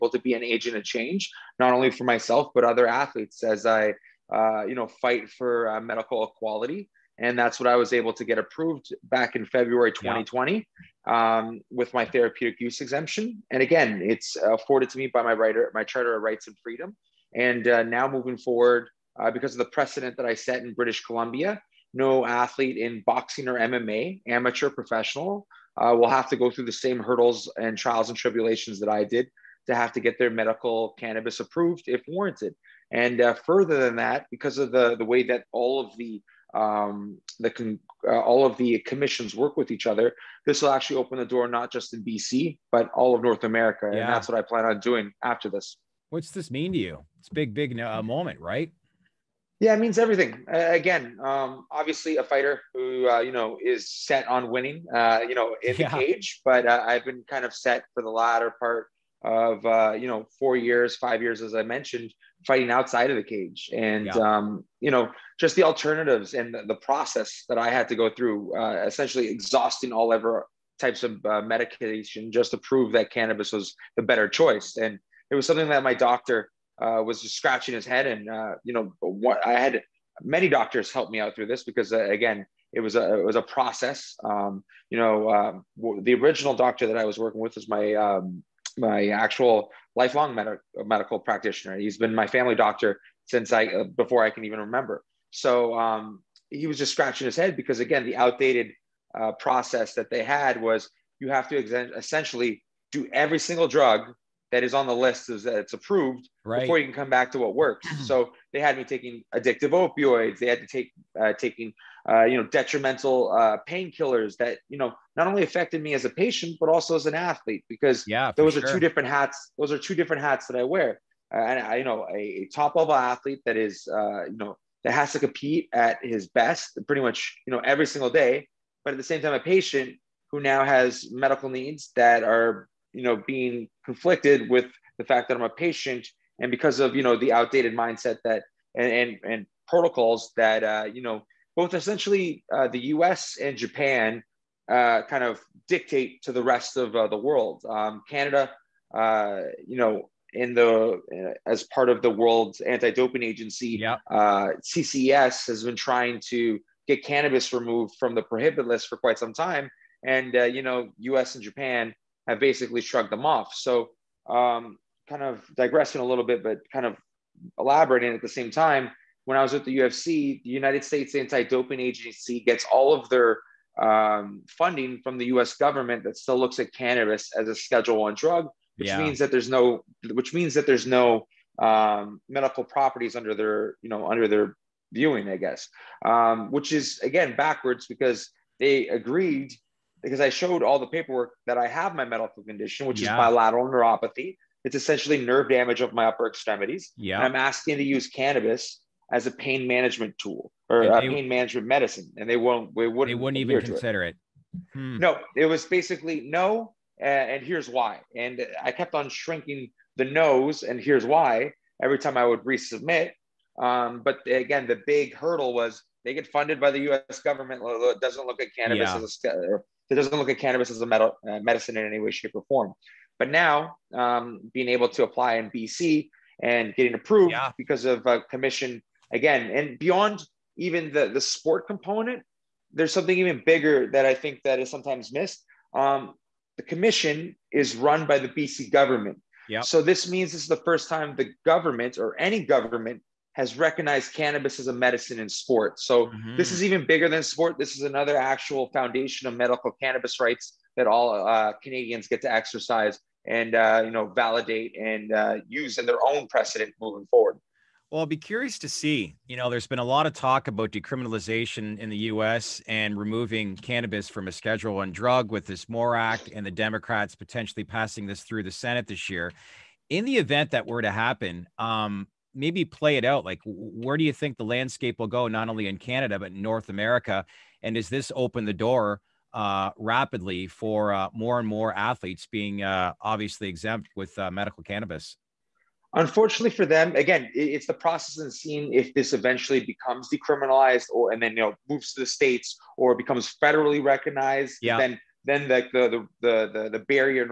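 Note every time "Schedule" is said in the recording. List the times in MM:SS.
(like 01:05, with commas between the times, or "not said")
02:57, 04:24.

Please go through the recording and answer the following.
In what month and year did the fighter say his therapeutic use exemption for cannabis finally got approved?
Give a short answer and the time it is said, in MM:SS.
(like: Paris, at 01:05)
February 2020, at 00:09.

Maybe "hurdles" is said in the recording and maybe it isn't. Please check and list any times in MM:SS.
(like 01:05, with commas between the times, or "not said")
00:26, 03:35.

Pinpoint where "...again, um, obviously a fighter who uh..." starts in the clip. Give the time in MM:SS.
00:50.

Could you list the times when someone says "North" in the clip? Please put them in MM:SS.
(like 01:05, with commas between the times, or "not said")
00:43, 04:36.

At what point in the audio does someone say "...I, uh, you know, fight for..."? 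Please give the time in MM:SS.
00:03.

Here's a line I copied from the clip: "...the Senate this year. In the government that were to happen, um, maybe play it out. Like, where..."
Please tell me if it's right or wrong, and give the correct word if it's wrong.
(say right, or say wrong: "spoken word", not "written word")
wrong: "event", not "government".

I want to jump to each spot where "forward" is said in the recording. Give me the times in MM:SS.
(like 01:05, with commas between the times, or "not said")
00:18, 04:17.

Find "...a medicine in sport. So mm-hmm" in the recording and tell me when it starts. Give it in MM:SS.
04:04.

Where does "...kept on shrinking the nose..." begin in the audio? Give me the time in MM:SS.
03:28.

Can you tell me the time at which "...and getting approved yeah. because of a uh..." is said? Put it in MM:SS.
03:46.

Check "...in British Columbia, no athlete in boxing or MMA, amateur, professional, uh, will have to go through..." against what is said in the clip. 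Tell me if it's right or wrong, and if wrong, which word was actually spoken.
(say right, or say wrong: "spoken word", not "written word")
right.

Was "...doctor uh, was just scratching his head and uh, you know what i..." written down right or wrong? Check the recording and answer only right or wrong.
right.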